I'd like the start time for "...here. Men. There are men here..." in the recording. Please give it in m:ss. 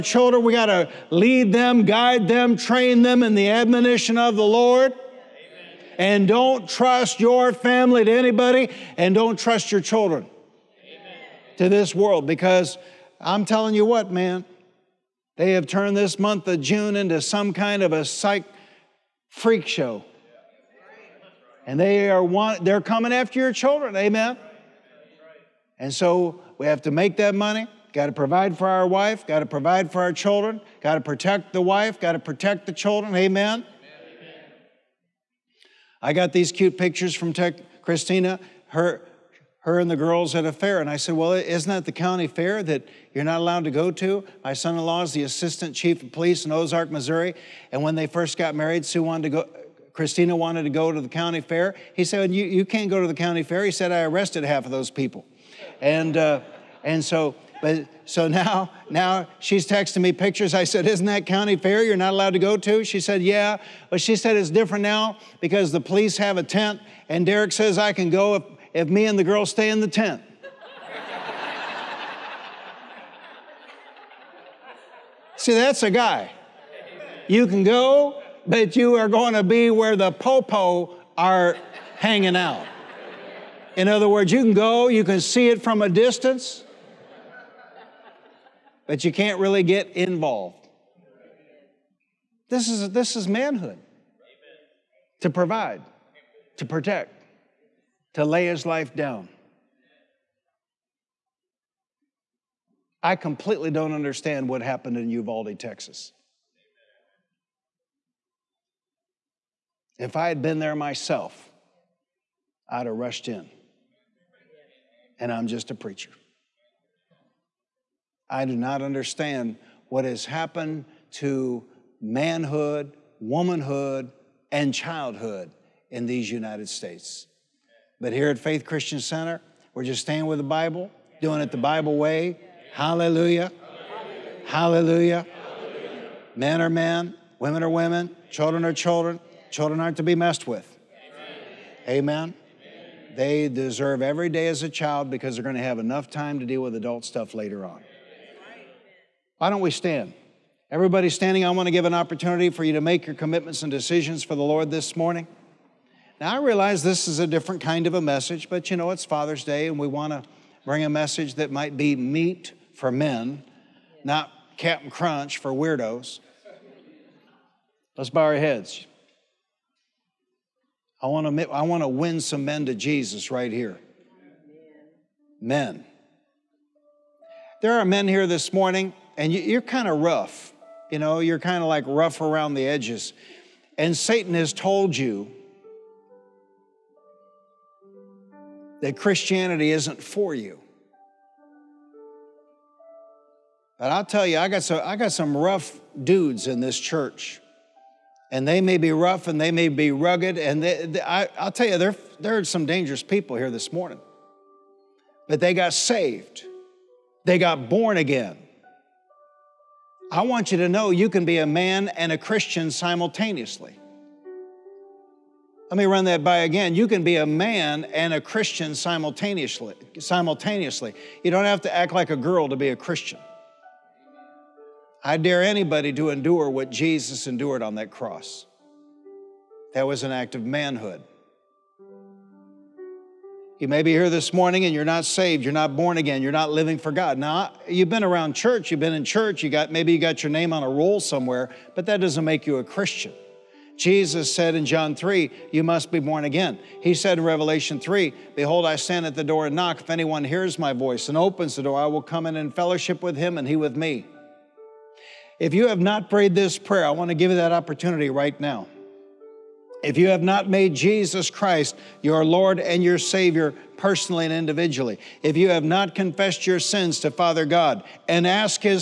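2:53.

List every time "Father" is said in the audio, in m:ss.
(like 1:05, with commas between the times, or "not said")
2:39, 4:27.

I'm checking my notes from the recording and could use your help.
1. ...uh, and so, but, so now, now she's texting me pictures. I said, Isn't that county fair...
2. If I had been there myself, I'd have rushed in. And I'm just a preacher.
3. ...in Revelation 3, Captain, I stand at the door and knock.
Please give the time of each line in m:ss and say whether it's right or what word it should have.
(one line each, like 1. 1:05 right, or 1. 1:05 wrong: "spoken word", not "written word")
1. 0:56 right
2. 1:49 right
3. 4:07 wrong: "Behold", not "Captain".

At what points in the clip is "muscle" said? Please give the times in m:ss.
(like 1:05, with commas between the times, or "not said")
not said.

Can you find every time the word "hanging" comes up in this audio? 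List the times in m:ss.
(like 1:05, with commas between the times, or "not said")
1:21.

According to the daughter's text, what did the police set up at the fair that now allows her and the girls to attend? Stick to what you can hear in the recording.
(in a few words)
A tent.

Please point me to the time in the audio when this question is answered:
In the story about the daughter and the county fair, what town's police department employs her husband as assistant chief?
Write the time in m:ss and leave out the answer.
0:46.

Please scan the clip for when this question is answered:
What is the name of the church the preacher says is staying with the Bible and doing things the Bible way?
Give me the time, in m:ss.
2:08.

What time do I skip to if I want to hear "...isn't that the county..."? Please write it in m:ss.
0:41.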